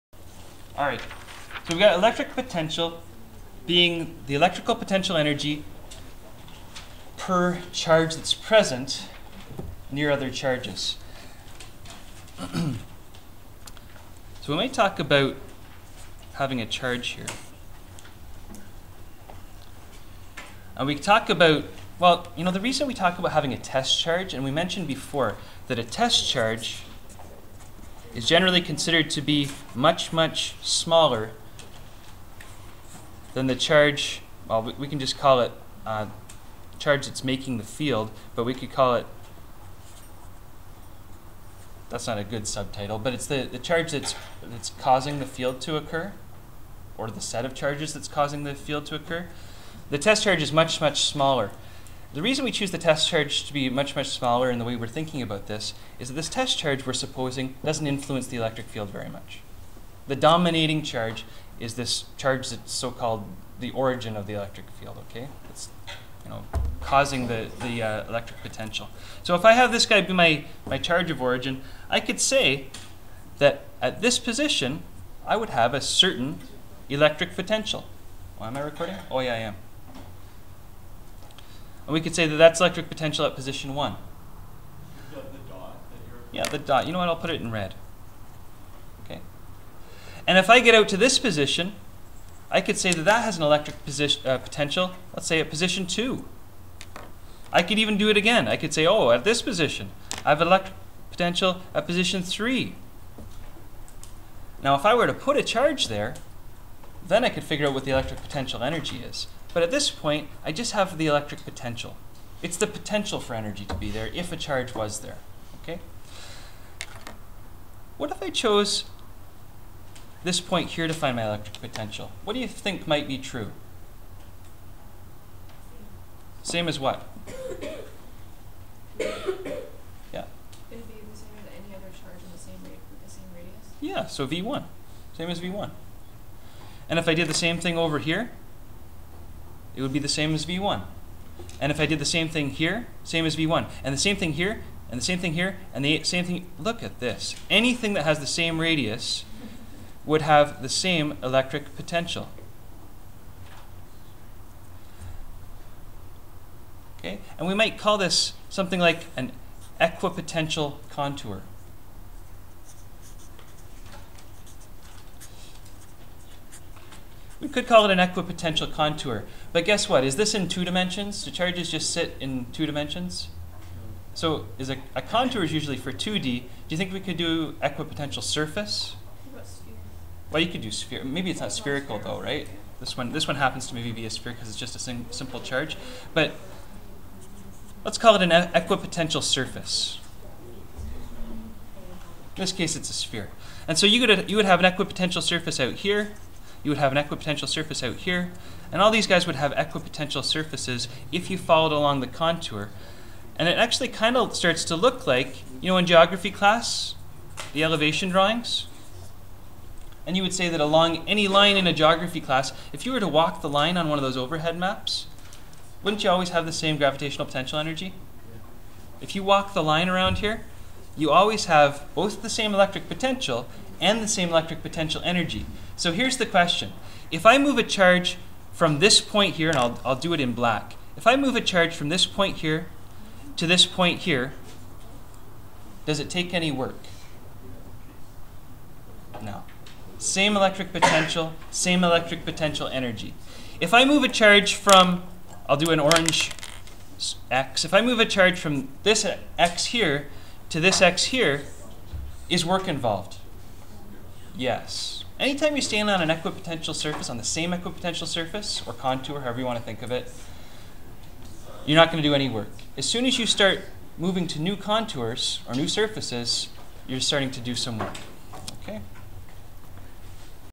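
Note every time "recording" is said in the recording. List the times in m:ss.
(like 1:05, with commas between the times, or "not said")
1:18.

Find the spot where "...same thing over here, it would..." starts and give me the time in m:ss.
2:17.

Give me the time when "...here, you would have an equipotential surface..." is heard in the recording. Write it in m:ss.
3:15.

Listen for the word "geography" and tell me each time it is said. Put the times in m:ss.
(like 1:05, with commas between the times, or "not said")
3:25, 3:31.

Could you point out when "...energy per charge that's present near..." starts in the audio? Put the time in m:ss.
0:05.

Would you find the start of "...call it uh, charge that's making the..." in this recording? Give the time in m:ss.
0:35.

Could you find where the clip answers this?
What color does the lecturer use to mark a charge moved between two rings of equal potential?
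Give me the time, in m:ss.
4:05.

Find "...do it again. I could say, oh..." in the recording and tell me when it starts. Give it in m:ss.
1:37.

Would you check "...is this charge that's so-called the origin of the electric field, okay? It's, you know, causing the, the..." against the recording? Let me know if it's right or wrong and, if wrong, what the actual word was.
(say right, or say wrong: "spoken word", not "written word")
right.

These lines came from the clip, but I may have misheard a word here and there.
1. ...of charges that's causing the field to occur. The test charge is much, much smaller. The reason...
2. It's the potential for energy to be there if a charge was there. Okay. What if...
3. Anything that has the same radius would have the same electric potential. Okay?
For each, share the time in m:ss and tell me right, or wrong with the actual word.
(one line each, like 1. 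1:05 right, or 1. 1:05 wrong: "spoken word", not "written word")
1. 0:47 right
2. 1:52 right
3. 2:27 right.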